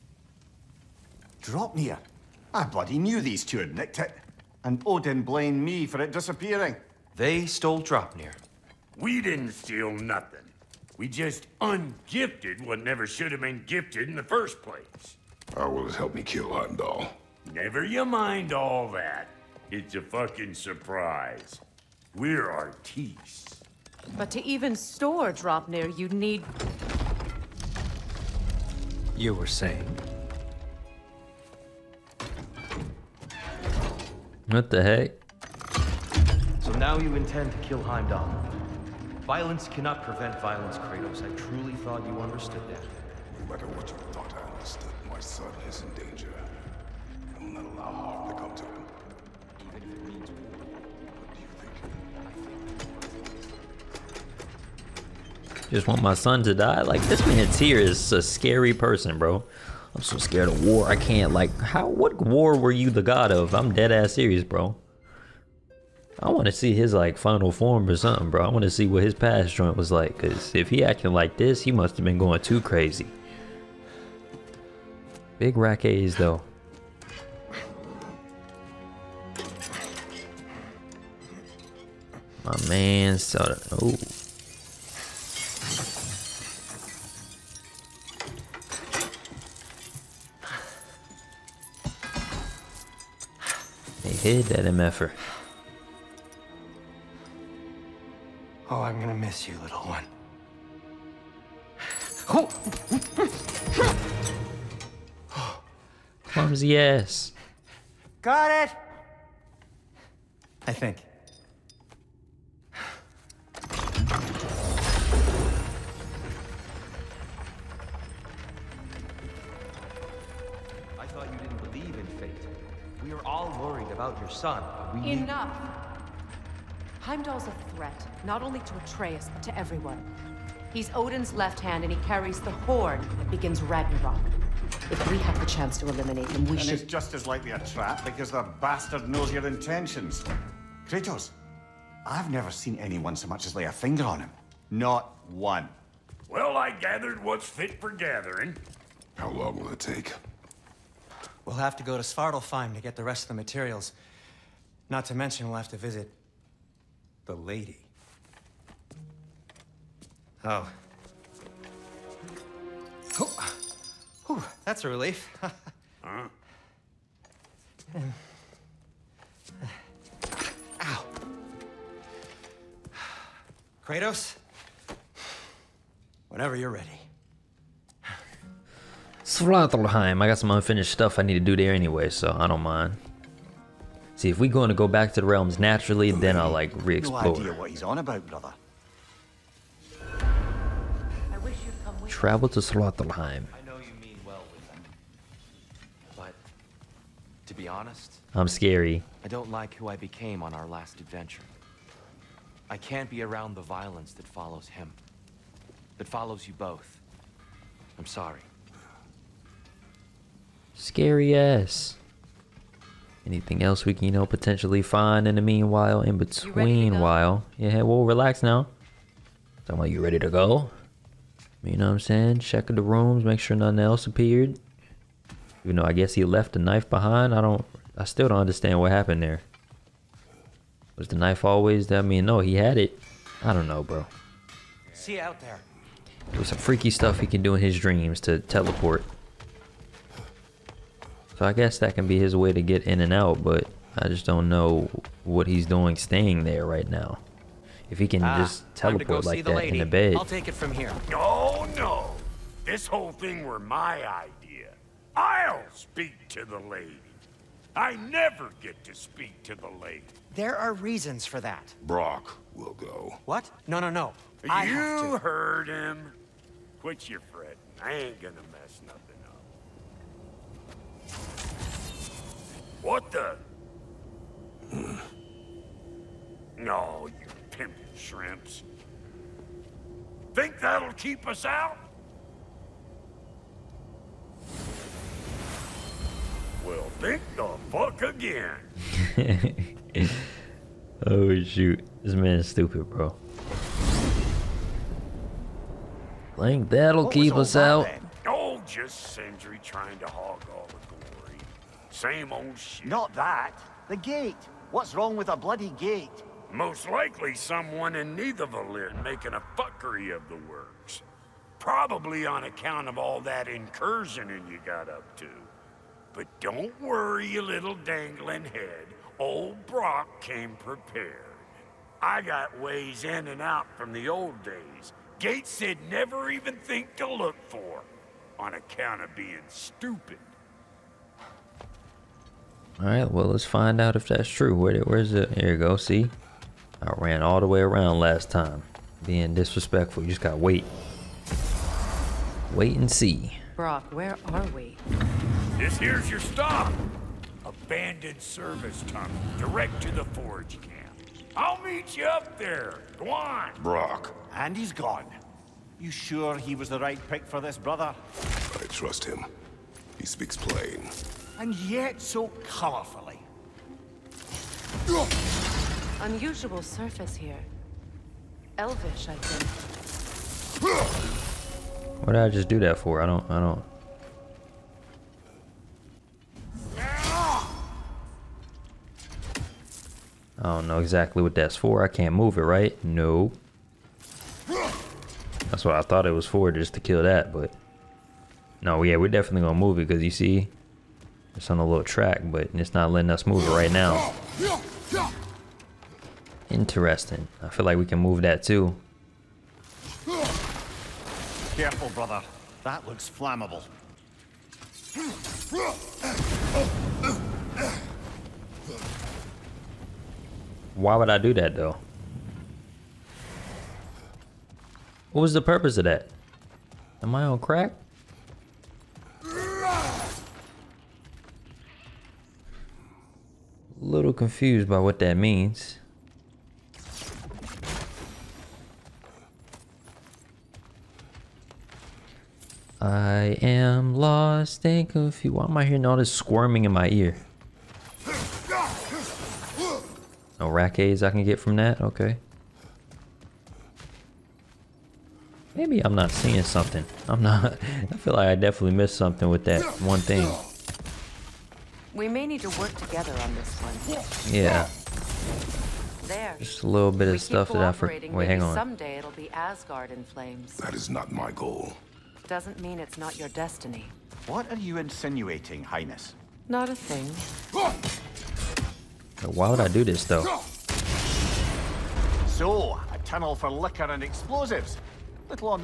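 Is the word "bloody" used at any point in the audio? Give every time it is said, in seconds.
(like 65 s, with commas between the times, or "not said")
2 s, 305 s.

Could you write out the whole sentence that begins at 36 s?
So now you intend to kill Heimdall.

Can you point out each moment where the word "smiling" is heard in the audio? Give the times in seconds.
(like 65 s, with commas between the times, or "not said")
not said.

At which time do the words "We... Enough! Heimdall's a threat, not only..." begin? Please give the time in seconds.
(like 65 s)
124 s.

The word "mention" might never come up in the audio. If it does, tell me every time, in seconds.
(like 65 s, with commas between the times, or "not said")
155 s.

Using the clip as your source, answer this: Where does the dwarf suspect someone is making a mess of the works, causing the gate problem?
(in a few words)
Nidavellir.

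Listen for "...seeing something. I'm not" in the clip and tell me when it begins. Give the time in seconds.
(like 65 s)
446 s.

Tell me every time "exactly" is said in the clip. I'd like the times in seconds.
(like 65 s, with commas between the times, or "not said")
380 s.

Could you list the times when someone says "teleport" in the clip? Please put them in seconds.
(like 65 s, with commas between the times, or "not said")
238 s, 248 s.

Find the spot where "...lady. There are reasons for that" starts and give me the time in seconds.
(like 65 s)
259 s.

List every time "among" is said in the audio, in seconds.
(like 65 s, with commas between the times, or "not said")
not said.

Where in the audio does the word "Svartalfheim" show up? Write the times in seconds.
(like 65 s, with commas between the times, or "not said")
152 s, 179 s.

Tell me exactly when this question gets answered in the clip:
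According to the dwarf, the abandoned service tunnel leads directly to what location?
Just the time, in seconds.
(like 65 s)
349 s.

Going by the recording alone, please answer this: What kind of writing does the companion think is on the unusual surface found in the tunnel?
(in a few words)
Elvish.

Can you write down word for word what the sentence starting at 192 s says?
Travel to Well but to be honest, I'm scary.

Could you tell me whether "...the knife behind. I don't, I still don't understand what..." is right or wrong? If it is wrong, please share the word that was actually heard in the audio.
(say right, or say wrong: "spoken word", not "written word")
right.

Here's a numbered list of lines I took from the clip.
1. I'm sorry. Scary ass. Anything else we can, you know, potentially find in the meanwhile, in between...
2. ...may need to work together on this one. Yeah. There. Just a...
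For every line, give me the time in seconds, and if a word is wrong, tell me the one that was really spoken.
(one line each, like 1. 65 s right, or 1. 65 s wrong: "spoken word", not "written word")
1. 207 s right
2. 452 s right.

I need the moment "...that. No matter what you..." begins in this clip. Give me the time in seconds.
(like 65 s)
42 s.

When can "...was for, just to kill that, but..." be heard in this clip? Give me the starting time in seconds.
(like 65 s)
386 s.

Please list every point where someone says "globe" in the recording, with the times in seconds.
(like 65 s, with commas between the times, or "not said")
not said.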